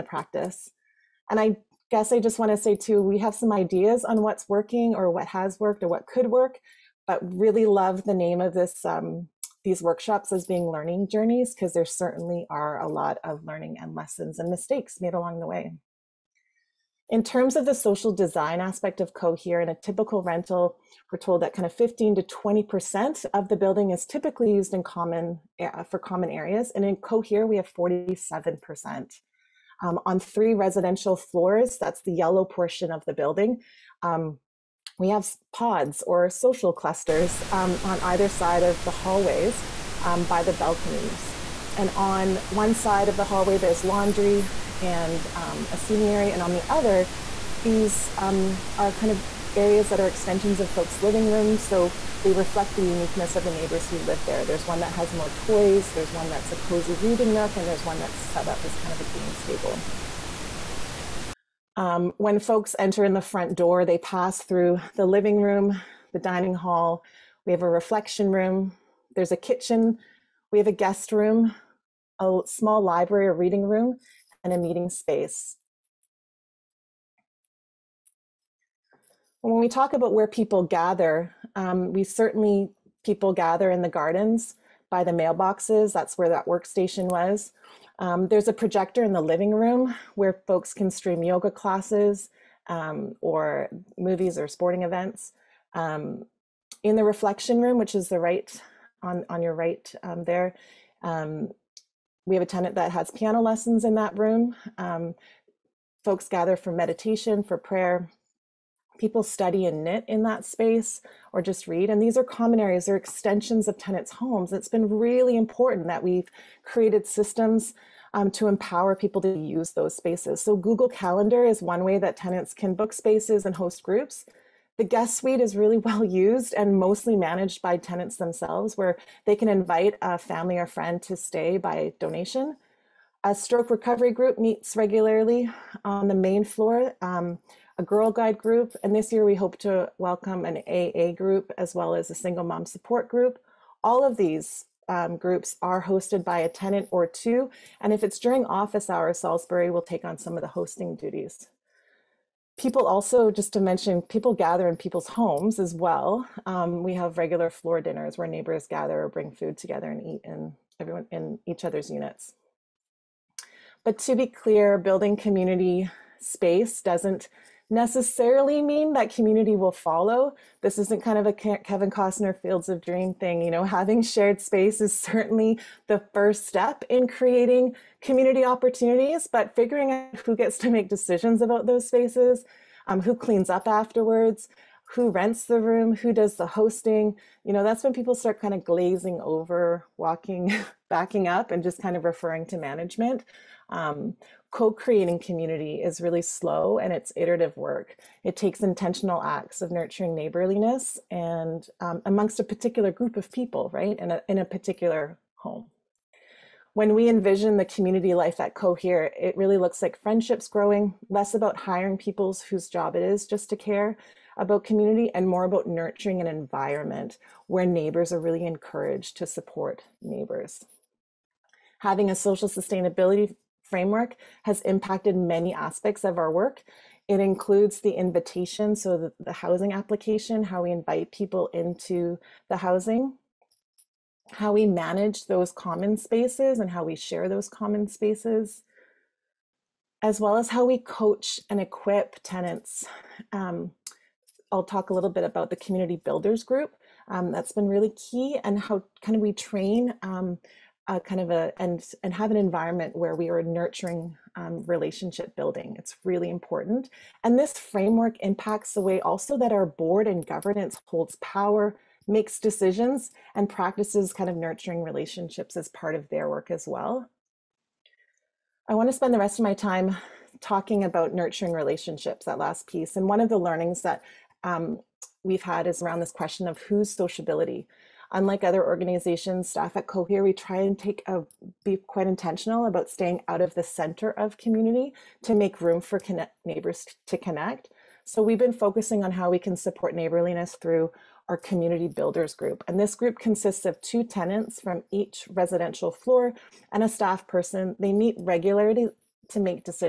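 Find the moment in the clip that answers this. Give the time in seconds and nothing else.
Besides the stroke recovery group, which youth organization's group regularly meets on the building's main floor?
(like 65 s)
137 s.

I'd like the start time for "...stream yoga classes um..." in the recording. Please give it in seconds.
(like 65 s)
90 s.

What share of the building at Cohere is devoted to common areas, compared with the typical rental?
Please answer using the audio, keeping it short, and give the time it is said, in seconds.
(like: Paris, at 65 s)
47%, at 27 s.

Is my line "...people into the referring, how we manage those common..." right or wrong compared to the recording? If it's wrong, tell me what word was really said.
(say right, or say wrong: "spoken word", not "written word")
wrong: "housing", not "referring".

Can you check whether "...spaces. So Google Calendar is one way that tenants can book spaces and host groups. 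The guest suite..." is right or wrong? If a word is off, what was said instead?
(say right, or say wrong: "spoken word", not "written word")
right.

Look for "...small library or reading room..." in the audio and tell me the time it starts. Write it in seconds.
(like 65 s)
72 s.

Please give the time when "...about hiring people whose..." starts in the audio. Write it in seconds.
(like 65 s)
211 s.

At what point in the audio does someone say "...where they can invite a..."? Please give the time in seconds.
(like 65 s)
128 s.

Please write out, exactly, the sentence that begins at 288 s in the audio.
So we've been focusing on how we can support neighborliness through our community builders group.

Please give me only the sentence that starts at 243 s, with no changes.
Um, I'll talk a little bit about the community builders group.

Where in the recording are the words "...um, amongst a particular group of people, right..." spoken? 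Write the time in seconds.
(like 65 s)
201 s.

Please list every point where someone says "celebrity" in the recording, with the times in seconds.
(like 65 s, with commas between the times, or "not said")
not said.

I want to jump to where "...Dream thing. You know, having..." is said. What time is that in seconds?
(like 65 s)
172 s.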